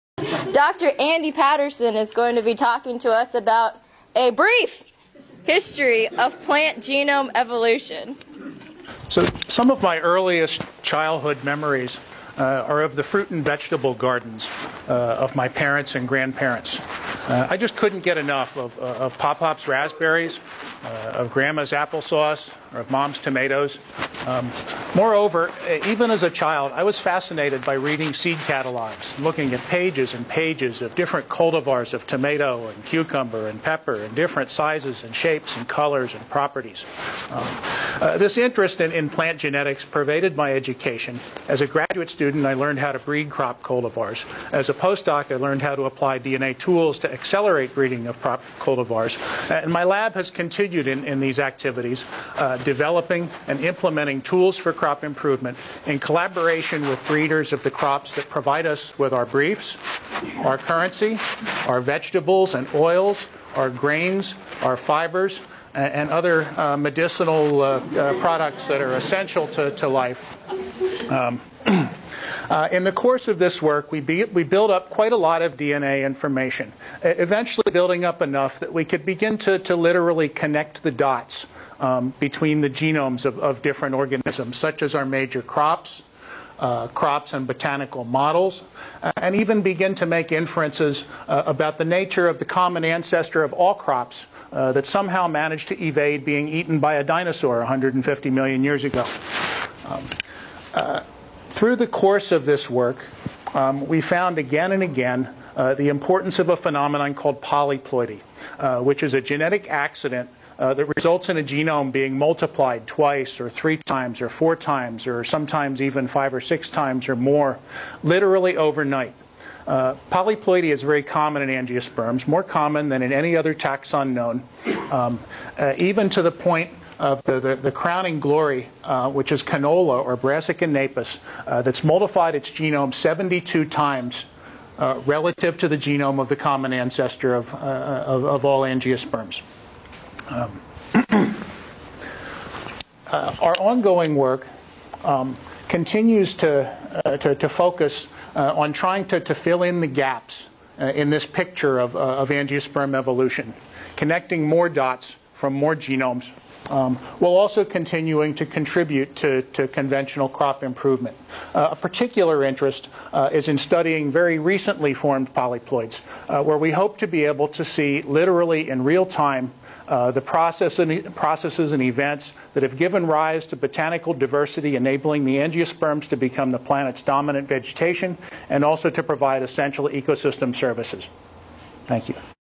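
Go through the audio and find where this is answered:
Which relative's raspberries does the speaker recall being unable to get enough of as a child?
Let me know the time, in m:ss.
0:19.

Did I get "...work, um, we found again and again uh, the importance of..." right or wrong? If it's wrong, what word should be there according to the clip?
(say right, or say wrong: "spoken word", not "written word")
right.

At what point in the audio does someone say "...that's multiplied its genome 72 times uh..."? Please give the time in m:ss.
2:11.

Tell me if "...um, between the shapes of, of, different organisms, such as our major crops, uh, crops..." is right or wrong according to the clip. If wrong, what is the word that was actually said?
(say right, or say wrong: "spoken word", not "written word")
wrong: "genomes", not "shapes".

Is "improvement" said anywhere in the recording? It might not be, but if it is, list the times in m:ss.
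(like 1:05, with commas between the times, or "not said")
0:55, 2:40.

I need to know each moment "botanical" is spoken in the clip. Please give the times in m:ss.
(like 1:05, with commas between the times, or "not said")
1:27, 2:53.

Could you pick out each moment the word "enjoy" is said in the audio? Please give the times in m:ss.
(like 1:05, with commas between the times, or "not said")
not said.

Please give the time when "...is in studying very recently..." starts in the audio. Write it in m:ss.
2:43.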